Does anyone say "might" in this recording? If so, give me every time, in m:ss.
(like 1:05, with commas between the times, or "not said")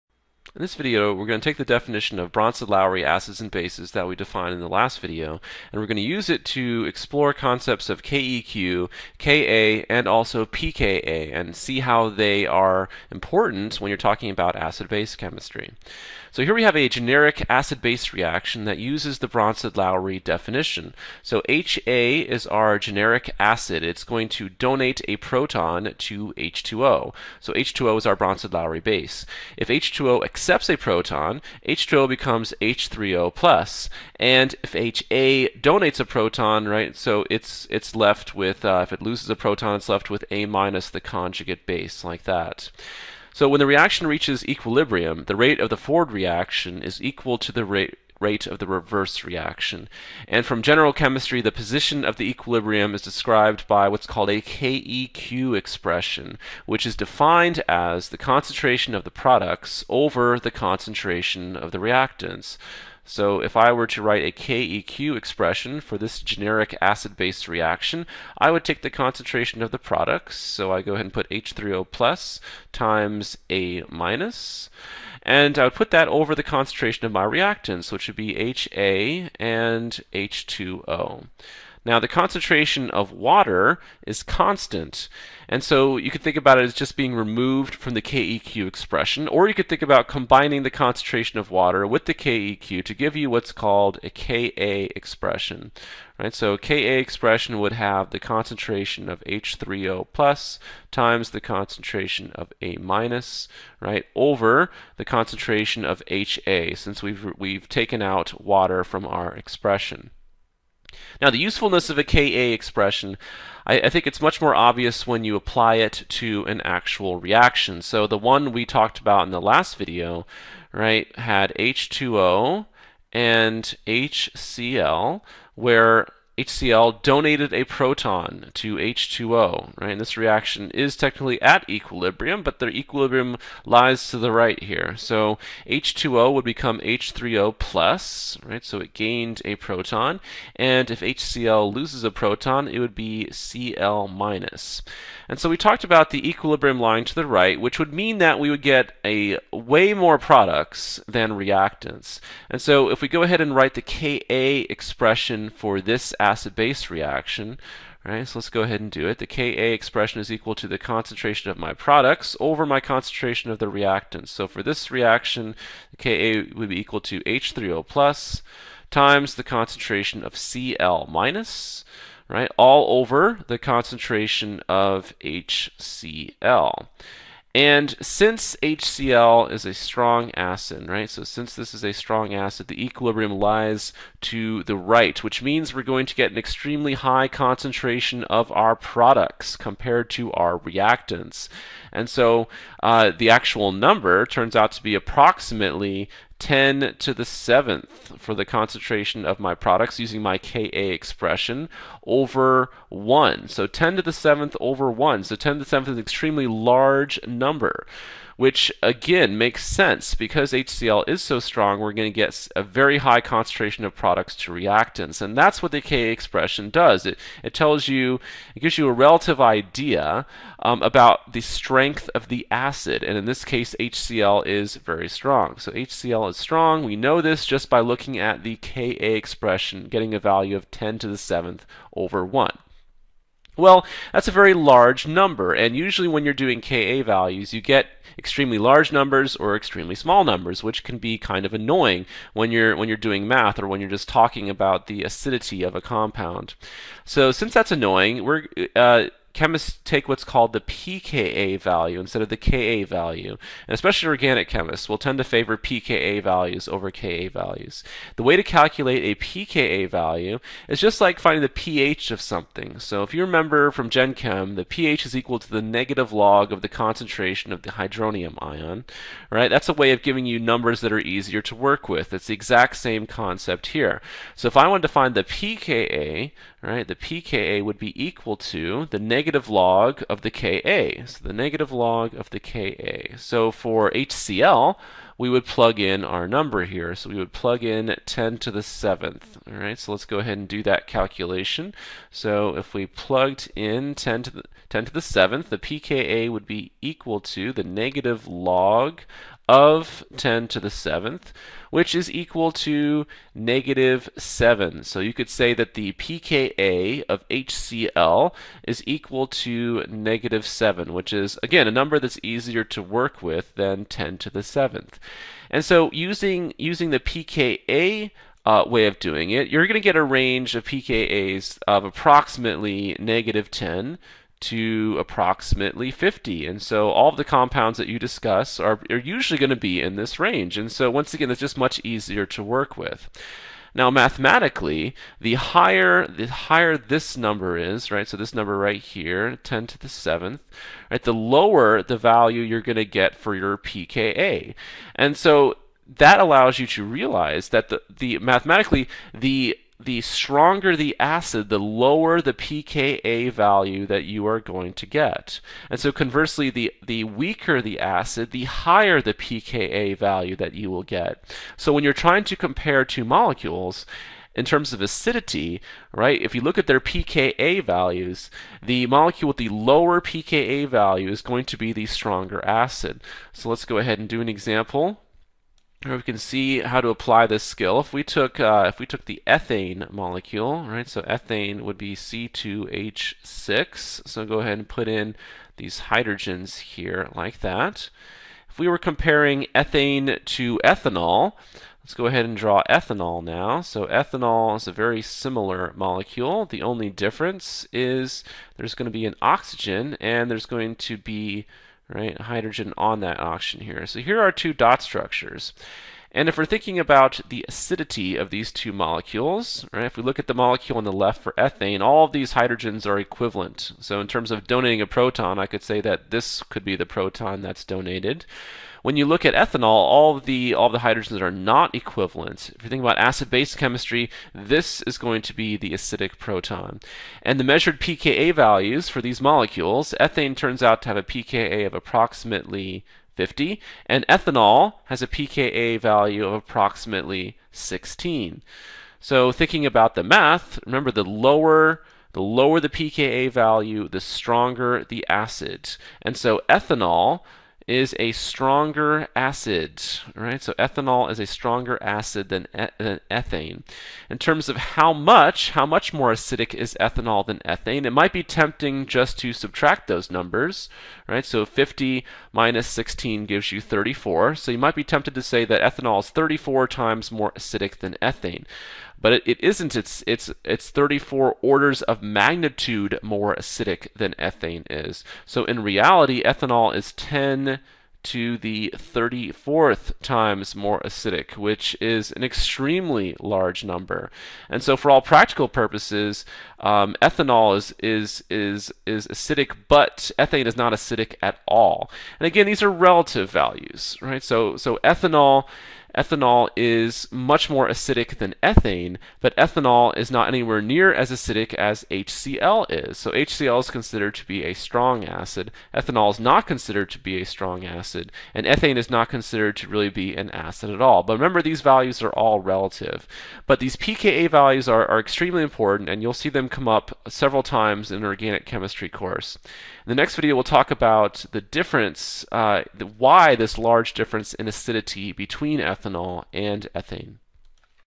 7:37, 7:44.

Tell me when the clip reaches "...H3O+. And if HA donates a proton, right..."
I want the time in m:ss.
0:32.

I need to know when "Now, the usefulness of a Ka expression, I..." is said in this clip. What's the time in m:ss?
1:51.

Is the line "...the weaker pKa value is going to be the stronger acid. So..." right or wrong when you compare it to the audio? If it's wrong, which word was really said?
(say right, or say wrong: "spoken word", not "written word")
wrong: "lower", not "weaker".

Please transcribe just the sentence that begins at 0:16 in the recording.
So here we have a generic acid-base reaction that uses the Bronsted-Lowry definition.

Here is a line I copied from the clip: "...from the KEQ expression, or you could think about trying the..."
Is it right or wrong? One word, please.
wrong.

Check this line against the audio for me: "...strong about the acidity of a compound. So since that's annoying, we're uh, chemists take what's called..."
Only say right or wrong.
wrong.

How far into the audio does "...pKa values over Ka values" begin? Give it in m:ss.
4:15.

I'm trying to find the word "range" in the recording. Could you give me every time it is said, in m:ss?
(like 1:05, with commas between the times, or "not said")
5:20, 5:30.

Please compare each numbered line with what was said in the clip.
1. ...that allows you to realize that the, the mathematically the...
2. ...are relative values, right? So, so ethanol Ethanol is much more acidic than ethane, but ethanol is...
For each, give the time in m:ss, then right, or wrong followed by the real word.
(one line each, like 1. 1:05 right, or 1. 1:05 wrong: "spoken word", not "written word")
1. 5:45 right
2. 8:12 right.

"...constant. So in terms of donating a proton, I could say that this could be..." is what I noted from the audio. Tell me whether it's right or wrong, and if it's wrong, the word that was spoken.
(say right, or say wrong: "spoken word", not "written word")
wrong: "equivalent", not "constant".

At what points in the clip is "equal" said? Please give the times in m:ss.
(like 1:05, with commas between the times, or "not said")
0:47, 2:40, 2:46, 4:25, 4:38, 4:56, 5:02, 5:08.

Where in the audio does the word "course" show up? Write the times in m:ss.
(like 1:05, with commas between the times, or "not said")
8:38.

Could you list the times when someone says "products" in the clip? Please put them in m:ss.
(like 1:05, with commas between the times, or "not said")
0:59, 1:09, 2:30, 2:41, 3:08, 3:19, 3:33.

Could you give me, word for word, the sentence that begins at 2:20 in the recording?
And if HCl loses a proton, it would be Cl minus.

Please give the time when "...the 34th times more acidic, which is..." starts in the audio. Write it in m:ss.
7:58.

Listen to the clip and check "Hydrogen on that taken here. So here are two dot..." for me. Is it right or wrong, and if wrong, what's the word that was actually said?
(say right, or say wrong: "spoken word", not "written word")
wrong: "oxygen", not "taken".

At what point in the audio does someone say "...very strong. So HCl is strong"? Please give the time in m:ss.
3:44.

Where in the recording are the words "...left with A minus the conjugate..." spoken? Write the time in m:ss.
0:39.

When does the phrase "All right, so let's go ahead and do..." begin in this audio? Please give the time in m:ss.
4:49.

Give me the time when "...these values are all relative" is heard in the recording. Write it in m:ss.
8:31.